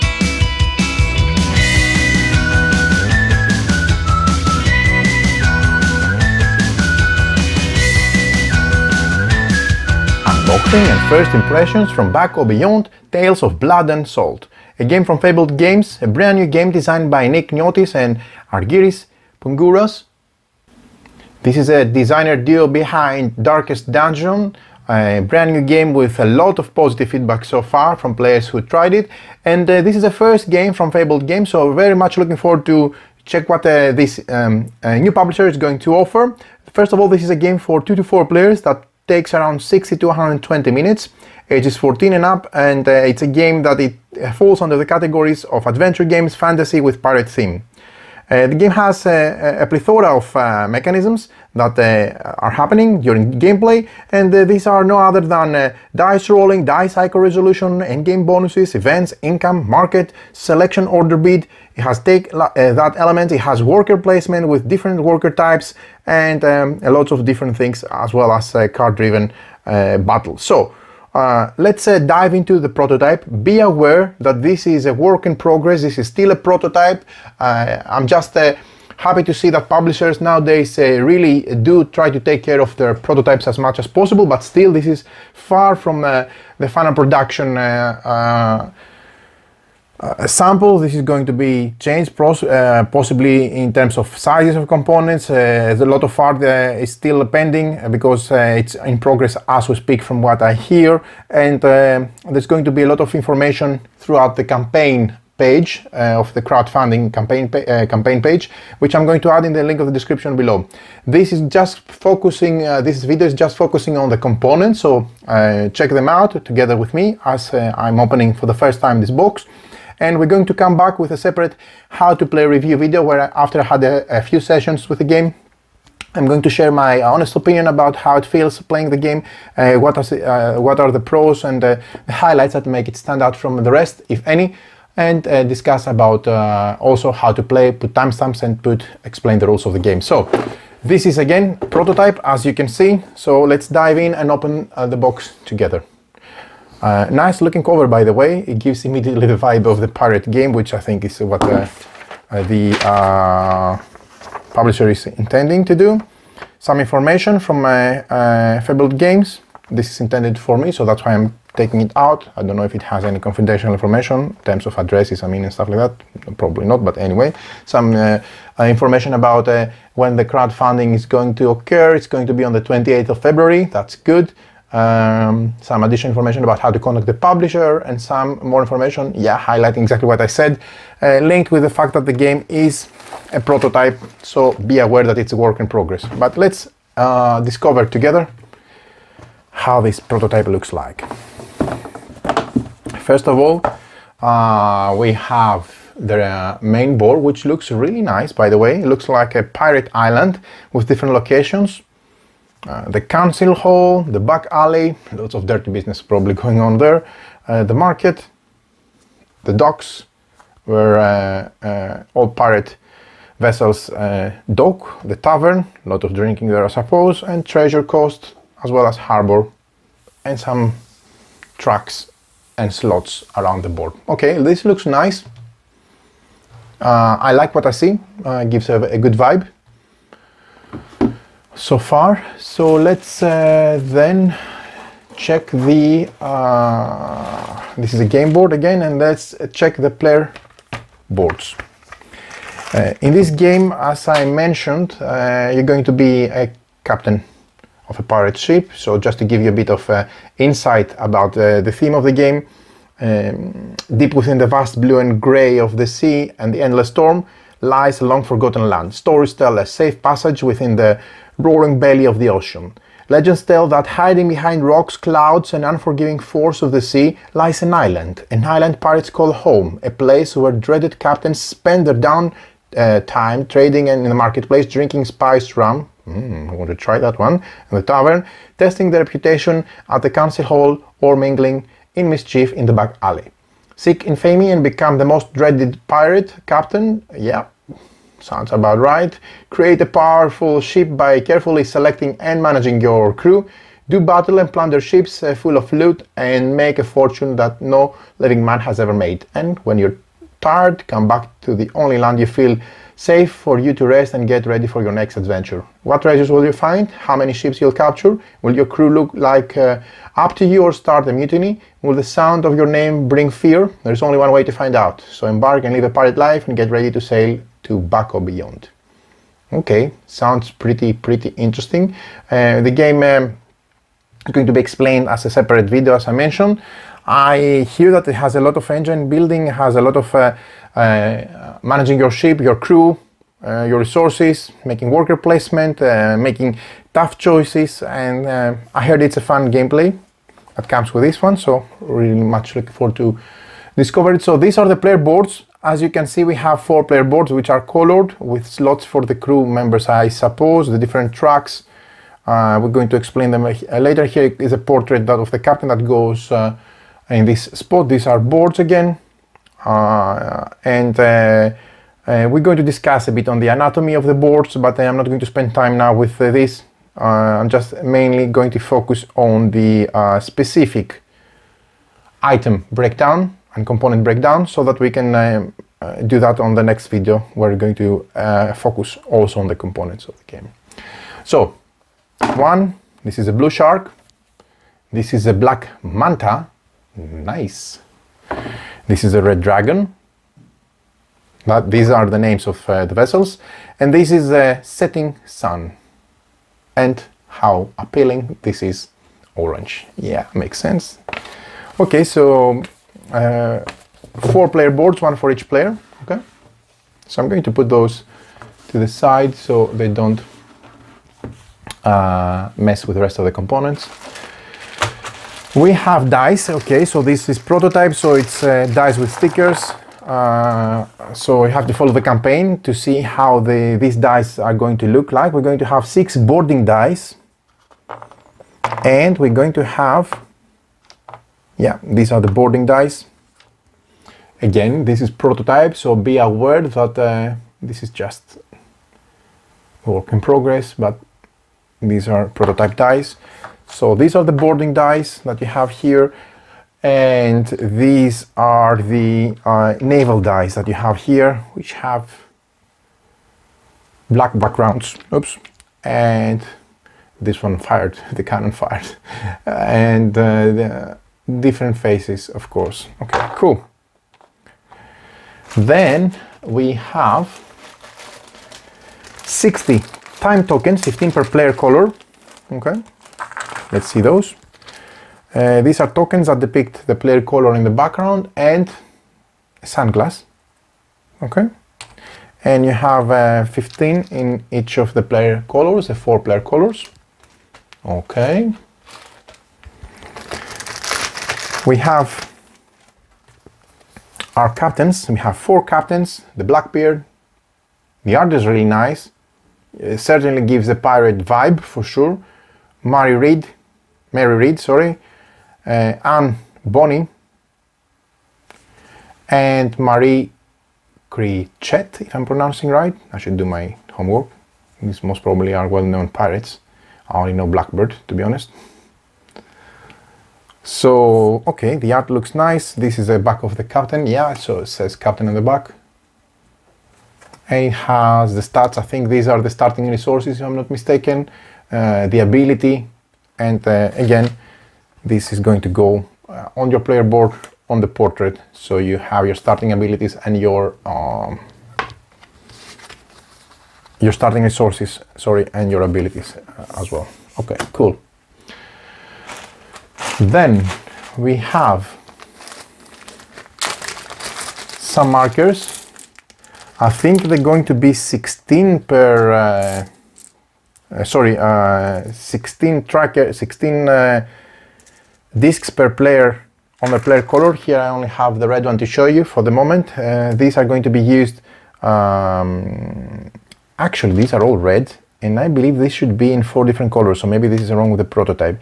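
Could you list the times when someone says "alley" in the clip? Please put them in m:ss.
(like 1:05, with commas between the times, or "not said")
3:24, 4:42.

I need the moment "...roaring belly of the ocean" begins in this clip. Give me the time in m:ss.
4:21.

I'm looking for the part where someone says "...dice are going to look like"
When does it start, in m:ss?
7:03.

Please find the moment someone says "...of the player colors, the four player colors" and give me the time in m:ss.
8:04.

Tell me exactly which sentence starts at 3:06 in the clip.
But let's uh, discover together how this prototype looks like.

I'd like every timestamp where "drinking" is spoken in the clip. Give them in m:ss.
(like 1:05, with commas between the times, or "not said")
3:36, 4:34.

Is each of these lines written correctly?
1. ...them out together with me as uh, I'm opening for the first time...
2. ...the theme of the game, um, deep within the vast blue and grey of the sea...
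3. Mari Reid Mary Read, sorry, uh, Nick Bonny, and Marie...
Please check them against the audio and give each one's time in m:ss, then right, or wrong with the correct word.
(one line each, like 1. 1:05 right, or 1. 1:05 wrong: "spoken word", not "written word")
1. 1:55 right
2. 4:11 right
3. 8:22 wrong: "Anne", not "Nick".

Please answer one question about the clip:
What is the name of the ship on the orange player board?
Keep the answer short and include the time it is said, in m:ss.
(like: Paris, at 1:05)
Setting Sun, at 6:34.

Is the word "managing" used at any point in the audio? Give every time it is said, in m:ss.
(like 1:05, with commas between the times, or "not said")
4:52, 5:31.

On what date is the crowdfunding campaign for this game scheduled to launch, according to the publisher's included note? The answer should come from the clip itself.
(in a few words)
28th of February.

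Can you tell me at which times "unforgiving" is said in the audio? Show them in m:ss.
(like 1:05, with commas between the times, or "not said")
4:25.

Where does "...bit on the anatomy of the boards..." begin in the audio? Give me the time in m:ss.
6:03.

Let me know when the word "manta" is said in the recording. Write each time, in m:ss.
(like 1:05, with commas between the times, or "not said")
6:25.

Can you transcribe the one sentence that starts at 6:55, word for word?
We have dice, okay, so this is prototype, so it's uh, dice with stickers.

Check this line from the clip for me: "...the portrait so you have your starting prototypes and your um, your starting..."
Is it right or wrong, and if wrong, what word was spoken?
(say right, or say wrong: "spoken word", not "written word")
wrong: "abilities", not "prototypes".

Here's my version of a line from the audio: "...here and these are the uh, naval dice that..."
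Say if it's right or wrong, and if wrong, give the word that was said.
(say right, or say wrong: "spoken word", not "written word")
right.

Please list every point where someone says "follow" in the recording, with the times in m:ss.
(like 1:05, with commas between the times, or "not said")
7:01.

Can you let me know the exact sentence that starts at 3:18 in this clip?
It looks like a pirate island with different locations.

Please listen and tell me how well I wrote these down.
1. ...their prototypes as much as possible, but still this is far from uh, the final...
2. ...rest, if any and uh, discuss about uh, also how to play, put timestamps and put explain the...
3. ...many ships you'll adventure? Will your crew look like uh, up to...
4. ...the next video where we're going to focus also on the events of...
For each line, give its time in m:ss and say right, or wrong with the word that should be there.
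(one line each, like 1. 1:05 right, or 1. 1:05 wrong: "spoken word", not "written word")
1. 1:22 right
2. 2:13 right
3. 5:07 wrong: "capture", not "adventure"
4. 6:16 wrong: "components", not "events".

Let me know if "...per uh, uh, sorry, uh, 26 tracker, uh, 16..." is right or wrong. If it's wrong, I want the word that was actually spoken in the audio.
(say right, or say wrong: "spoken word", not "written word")
wrong: "16", not "26".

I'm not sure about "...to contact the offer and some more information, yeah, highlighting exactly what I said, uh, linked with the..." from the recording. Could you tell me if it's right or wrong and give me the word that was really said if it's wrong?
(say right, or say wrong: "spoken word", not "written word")
wrong: "publisher", not "offer".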